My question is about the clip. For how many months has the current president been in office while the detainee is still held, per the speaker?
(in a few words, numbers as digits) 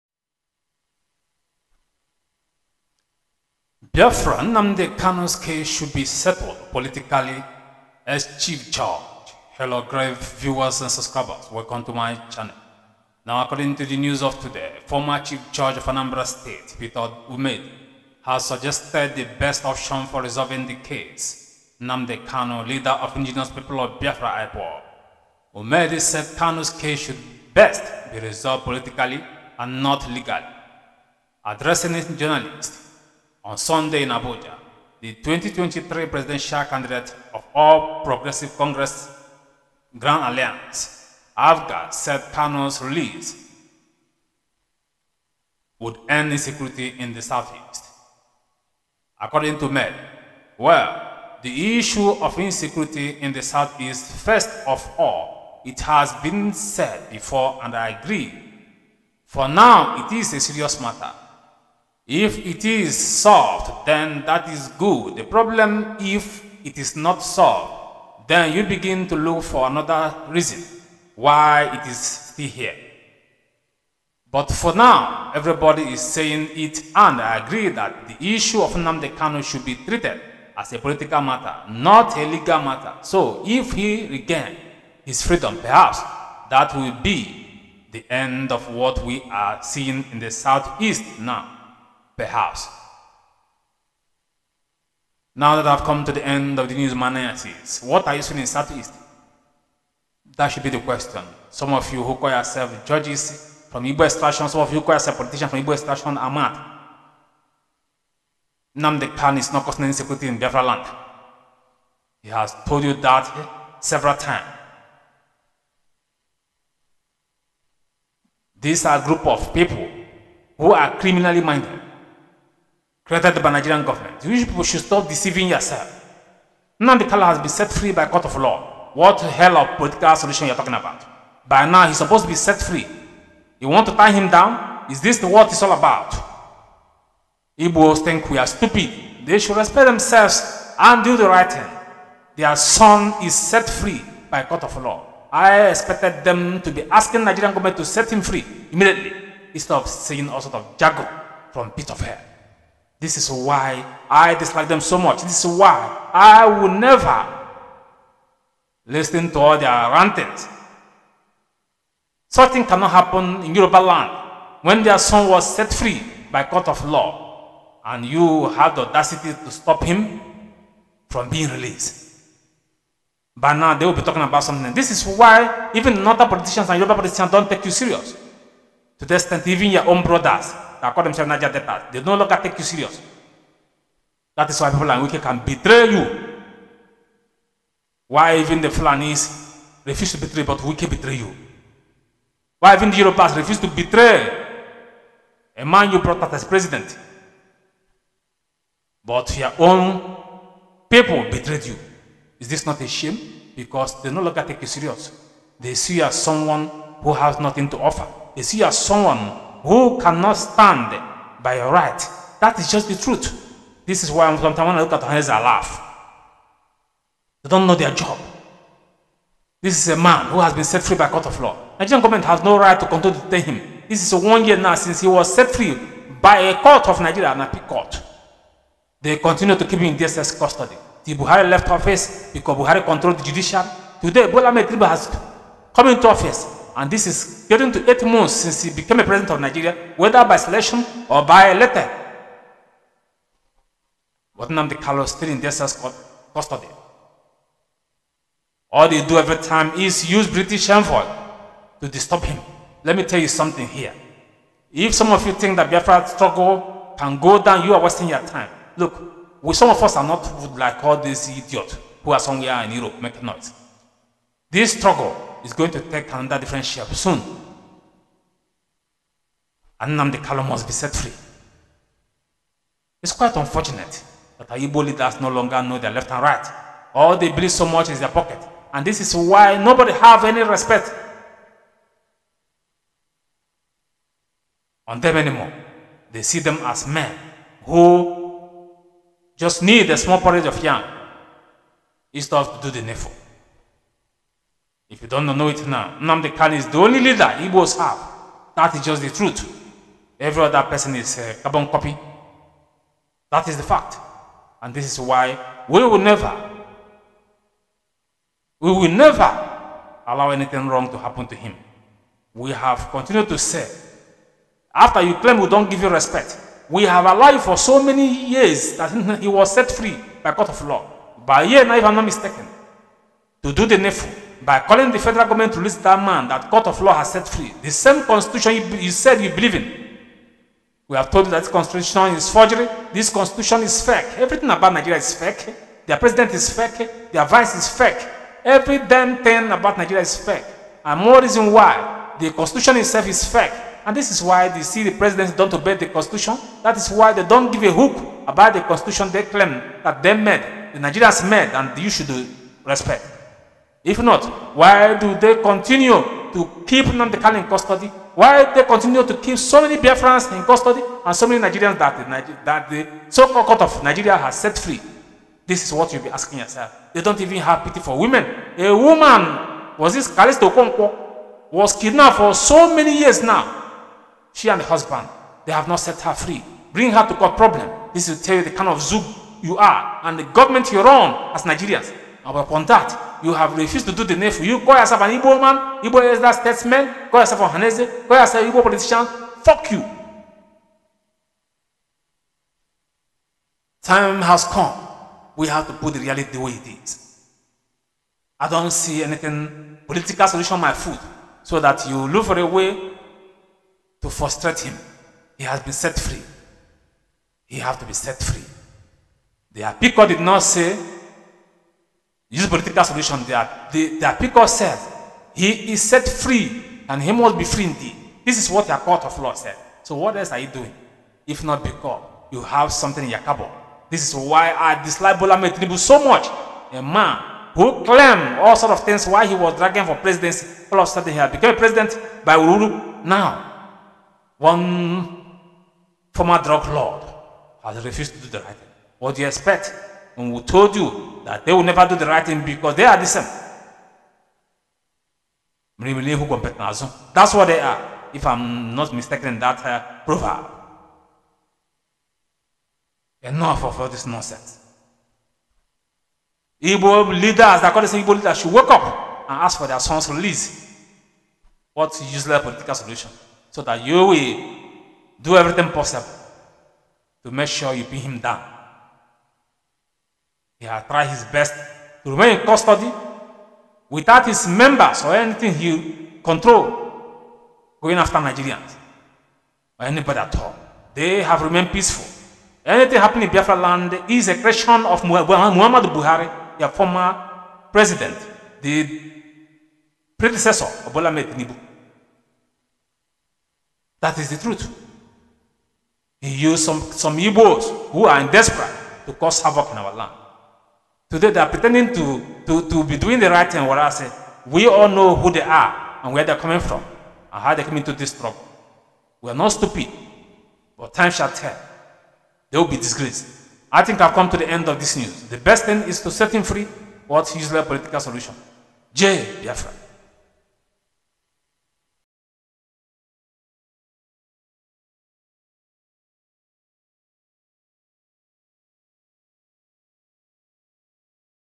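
8.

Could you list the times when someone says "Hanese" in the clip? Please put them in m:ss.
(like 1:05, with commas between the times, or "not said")
6:27.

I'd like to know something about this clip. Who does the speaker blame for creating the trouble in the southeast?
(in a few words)
Muhammad Buhari.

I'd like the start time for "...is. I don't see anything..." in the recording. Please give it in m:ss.
6:36.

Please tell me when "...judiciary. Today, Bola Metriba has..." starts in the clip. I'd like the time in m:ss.
3:53.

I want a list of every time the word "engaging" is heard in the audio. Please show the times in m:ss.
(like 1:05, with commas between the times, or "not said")
not said.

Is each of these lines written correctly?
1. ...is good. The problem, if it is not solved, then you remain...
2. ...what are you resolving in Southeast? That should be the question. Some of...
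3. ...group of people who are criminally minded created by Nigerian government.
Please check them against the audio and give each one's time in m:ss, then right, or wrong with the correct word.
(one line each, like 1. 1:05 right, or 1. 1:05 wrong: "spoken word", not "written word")
1. 1:04 wrong: "begin", not "remain"
2. 1:37 wrong: "seeing", not "resolving"
3. 1:59 right.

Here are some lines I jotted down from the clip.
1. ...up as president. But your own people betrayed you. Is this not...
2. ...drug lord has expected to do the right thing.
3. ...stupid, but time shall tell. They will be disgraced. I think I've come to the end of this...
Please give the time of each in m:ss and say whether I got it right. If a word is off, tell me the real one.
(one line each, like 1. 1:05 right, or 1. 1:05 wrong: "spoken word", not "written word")
1. 3:16 right
2. 7:16 wrong: "refused", not "expected"
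3. 8:29 right.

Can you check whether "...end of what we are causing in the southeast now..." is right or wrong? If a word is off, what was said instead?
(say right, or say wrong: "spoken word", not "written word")
wrong: "seeing", not "causing".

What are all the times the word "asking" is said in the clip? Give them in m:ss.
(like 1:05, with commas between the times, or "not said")
2:26, 6:06.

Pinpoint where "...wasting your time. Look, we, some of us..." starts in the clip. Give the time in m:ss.
4:17.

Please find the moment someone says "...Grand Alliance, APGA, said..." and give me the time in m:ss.
0:39.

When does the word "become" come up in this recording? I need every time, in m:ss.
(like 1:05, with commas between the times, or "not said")
7:11.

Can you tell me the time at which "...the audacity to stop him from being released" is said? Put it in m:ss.
2:48.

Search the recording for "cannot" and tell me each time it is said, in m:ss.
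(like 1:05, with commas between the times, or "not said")
2:42, 3:29.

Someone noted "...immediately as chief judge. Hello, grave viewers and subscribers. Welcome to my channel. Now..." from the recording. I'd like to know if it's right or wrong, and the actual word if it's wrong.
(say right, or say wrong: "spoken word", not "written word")
wrong: "politically", not "immediately".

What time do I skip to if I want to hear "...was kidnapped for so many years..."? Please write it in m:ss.
6:11.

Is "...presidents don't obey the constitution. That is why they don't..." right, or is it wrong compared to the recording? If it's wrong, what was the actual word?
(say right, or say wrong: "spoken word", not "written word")
right.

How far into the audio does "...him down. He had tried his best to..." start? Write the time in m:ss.
7:47.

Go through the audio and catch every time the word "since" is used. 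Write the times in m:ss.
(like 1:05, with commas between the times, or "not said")
3:44, 3:58.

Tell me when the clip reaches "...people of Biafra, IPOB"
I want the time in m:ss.
0:23.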